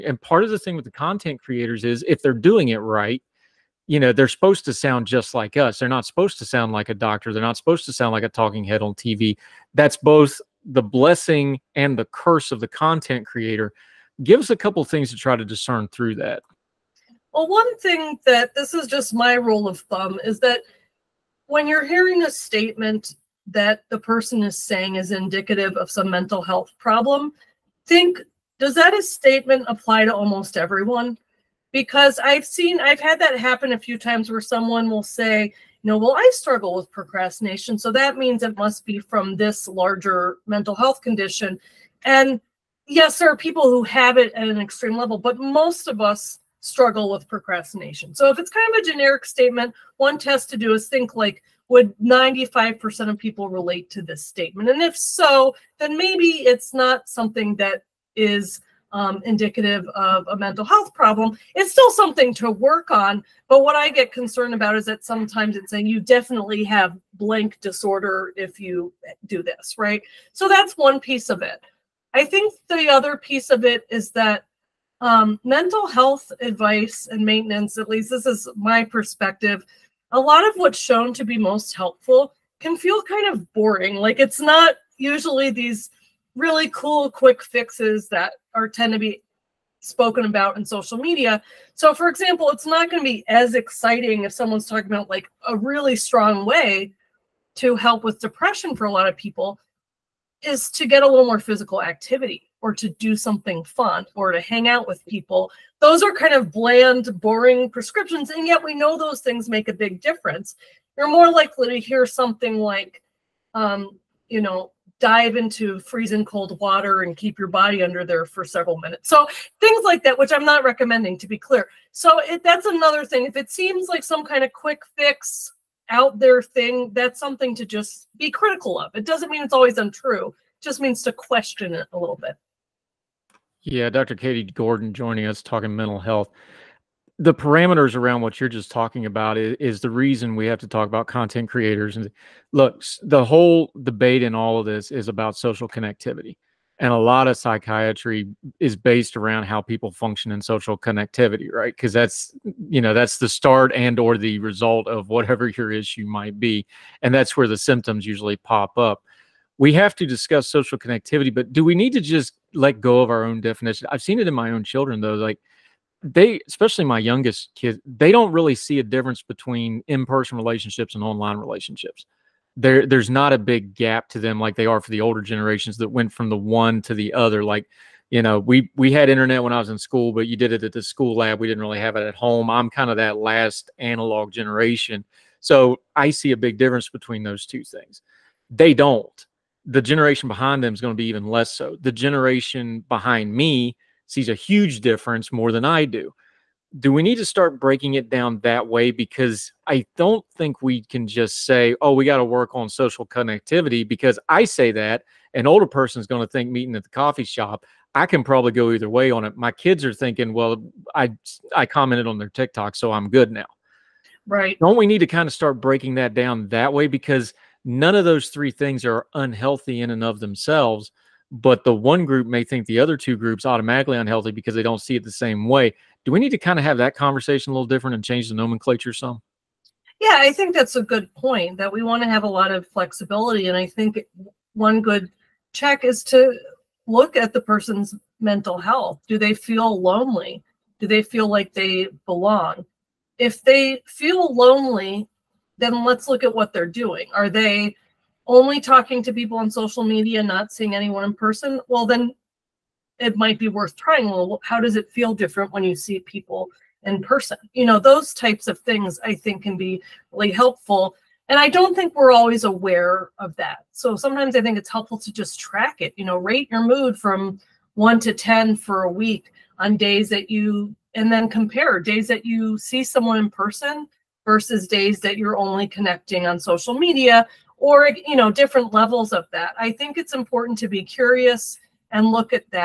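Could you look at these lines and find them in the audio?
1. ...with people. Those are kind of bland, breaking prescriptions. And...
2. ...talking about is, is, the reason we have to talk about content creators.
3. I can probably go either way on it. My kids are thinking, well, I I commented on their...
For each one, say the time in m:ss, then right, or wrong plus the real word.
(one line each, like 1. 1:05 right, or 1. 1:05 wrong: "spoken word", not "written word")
1. 1:44 wrong: "boring", not "breaking"
2. 2:18 right
3. 3:27 right.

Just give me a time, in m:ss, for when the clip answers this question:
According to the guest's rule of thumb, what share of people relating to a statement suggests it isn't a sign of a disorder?
0:51.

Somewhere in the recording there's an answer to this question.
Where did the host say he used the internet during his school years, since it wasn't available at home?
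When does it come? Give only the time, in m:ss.
3:00.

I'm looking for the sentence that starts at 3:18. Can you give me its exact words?
Because I don't think we can just say, oh, we got to work on social connectivity because I say that.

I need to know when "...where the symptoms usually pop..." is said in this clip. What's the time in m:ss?
2:37.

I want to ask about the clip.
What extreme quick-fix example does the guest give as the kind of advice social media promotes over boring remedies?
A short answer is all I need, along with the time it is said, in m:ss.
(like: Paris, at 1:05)
freezing cold water, at 1:55.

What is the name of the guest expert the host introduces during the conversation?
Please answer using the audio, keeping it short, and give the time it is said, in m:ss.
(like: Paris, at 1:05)
Dr. Katie Gordon, at 2:13.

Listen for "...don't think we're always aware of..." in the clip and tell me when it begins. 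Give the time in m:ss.
4:21.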